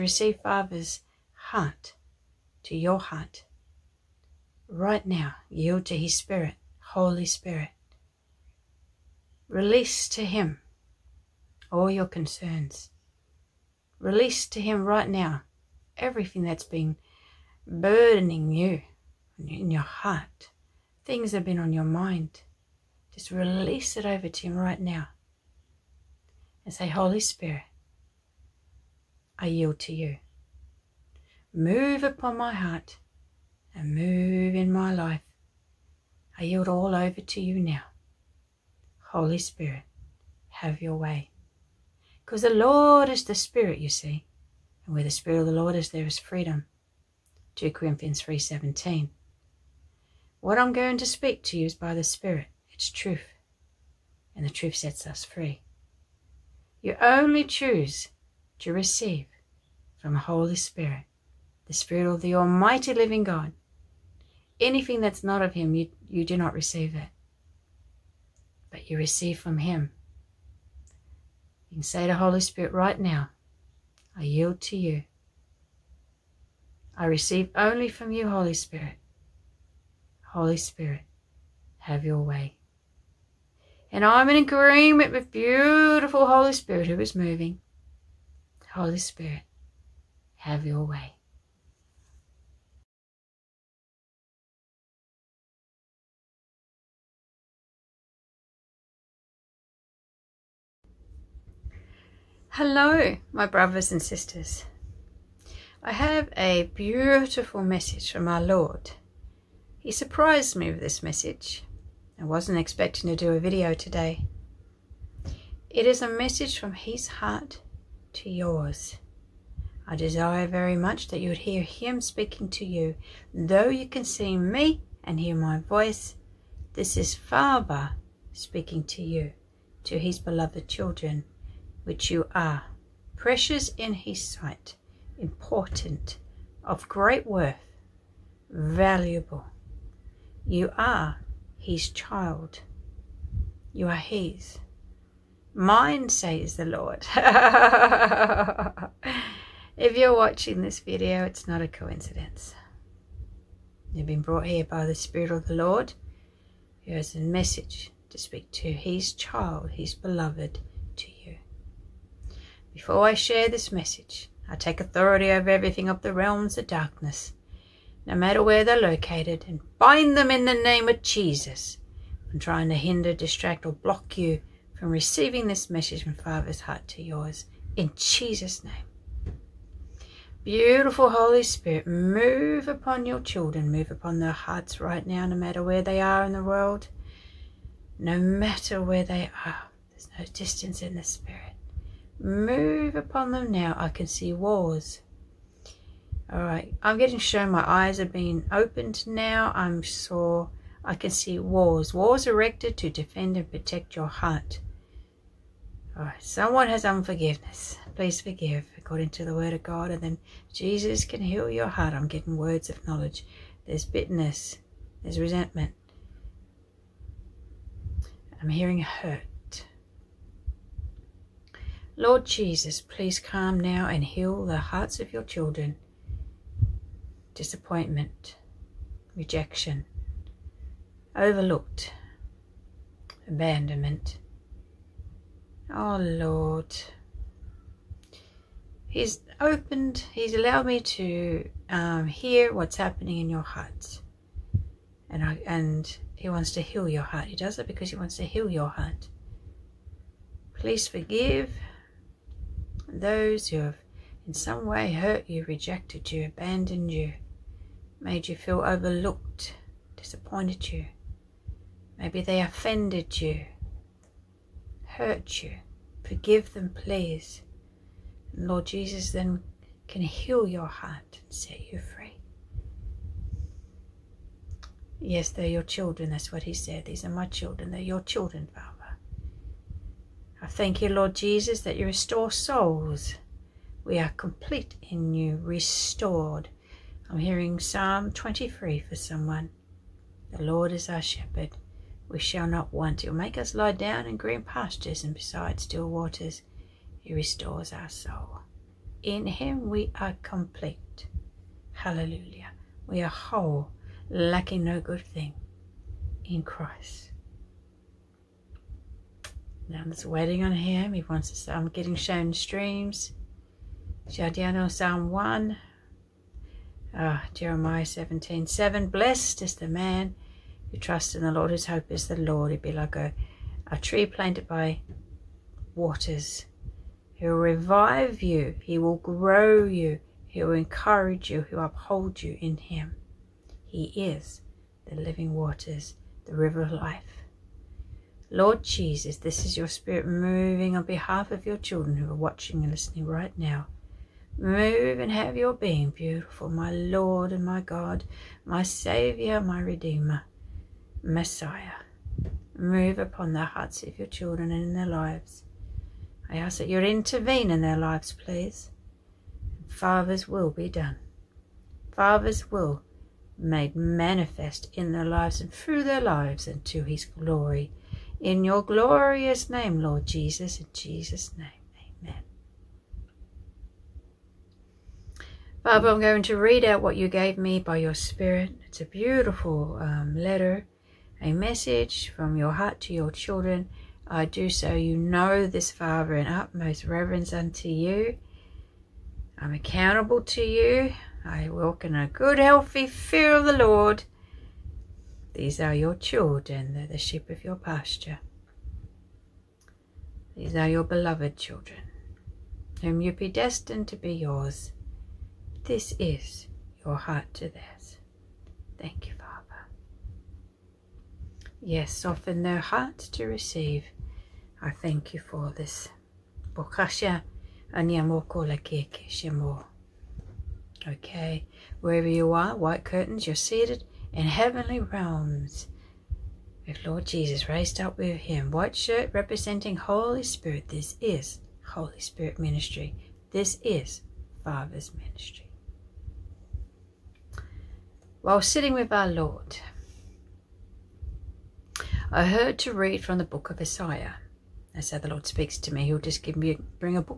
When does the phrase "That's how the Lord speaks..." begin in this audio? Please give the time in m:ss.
7:24.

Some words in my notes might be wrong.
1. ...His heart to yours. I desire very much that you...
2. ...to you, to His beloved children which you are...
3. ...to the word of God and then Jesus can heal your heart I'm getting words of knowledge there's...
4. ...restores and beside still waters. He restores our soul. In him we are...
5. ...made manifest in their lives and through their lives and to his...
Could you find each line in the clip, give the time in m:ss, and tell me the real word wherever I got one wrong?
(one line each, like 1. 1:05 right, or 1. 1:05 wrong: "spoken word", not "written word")
1. 1:56 right
2. 2:08 right
3. 3:29 right
4. 4:54 wrong: "pastures", not "restores"
5. 6:03 right.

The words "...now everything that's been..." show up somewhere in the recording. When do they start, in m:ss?
0:15.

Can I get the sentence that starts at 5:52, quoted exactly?
Move upon the hearts of your children and in their lives.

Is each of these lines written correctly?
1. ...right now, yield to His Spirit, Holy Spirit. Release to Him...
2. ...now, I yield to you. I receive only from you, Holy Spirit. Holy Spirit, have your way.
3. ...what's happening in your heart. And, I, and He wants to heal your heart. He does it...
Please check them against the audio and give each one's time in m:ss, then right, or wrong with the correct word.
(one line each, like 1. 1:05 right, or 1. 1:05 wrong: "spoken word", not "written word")
1. 0:04 right
2. 1:13 right
3. 4:02 right.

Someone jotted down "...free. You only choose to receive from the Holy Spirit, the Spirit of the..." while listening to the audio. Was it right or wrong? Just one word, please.
right.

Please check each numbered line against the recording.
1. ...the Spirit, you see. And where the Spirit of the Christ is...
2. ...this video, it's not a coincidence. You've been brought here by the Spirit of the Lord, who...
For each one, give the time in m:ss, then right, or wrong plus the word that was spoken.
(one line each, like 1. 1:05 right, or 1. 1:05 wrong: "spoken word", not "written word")
1. 0:43 wrong: "Lord", not "Christ"
2. 2:30 right.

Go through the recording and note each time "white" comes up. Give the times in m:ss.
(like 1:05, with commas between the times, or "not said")
7:02, 7:08.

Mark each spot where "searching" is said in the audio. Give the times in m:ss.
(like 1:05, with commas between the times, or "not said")
not said.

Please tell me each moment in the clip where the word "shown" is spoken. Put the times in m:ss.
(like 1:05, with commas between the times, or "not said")
3:17, 5:11.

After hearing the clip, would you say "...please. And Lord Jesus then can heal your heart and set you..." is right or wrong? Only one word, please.
right.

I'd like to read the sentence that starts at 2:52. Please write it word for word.
I'm trying to hinder, distract, or block you from receiving this message from Father's heart to yours.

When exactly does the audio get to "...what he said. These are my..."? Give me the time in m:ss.
4:36.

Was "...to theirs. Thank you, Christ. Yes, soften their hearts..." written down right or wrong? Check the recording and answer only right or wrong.
wrong.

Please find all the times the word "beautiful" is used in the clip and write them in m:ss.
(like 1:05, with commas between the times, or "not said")
1:25, 1:46, 3:00, 5:45, 6:18.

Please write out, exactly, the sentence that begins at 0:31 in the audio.
Move upon my heart and move in my life.